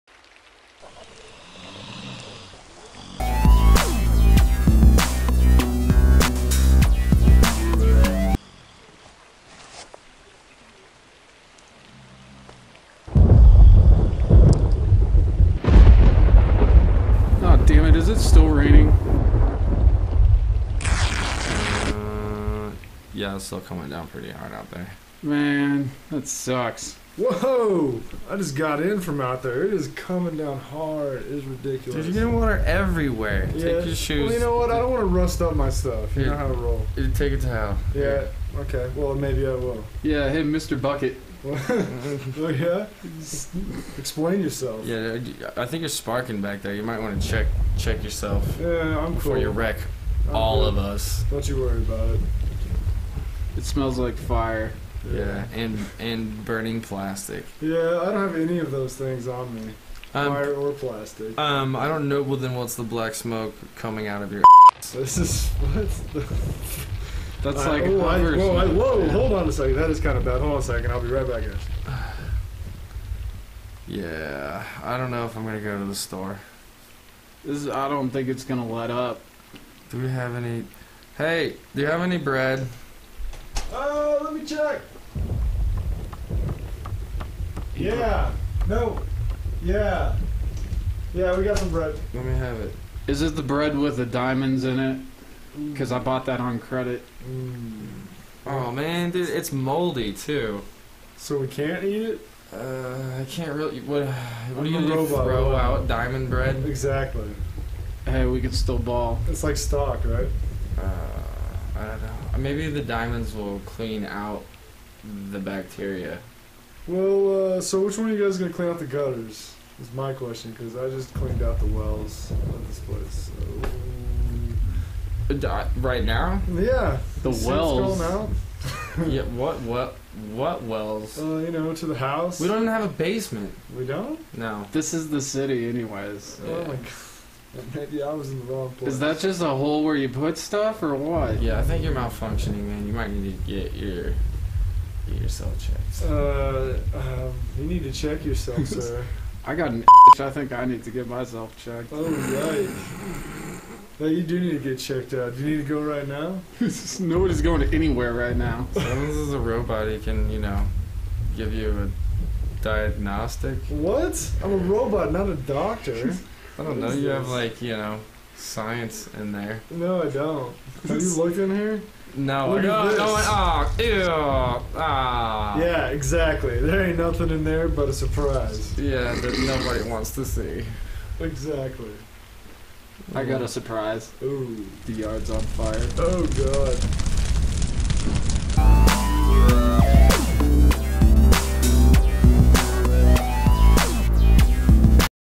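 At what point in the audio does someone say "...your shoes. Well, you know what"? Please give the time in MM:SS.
00:33.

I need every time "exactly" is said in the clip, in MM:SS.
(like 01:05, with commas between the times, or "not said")
01:46, 02:55, 03:01.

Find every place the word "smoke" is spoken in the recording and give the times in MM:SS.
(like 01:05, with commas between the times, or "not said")
01:03.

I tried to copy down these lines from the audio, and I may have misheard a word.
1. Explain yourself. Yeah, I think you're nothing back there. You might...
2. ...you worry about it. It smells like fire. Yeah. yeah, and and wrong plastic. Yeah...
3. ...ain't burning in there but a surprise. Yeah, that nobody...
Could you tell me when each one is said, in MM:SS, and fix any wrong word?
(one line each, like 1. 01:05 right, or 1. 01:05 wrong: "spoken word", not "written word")
1. 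00:43 wrong: "sparking", not "nothing"
2. 00:51 wrong: "burning", not "wrong"
3. 02:56 wrong: "nothing", not "burning".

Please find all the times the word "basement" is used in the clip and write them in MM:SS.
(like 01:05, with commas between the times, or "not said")
02:12.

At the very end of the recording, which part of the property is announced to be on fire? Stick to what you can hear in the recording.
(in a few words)
the yard.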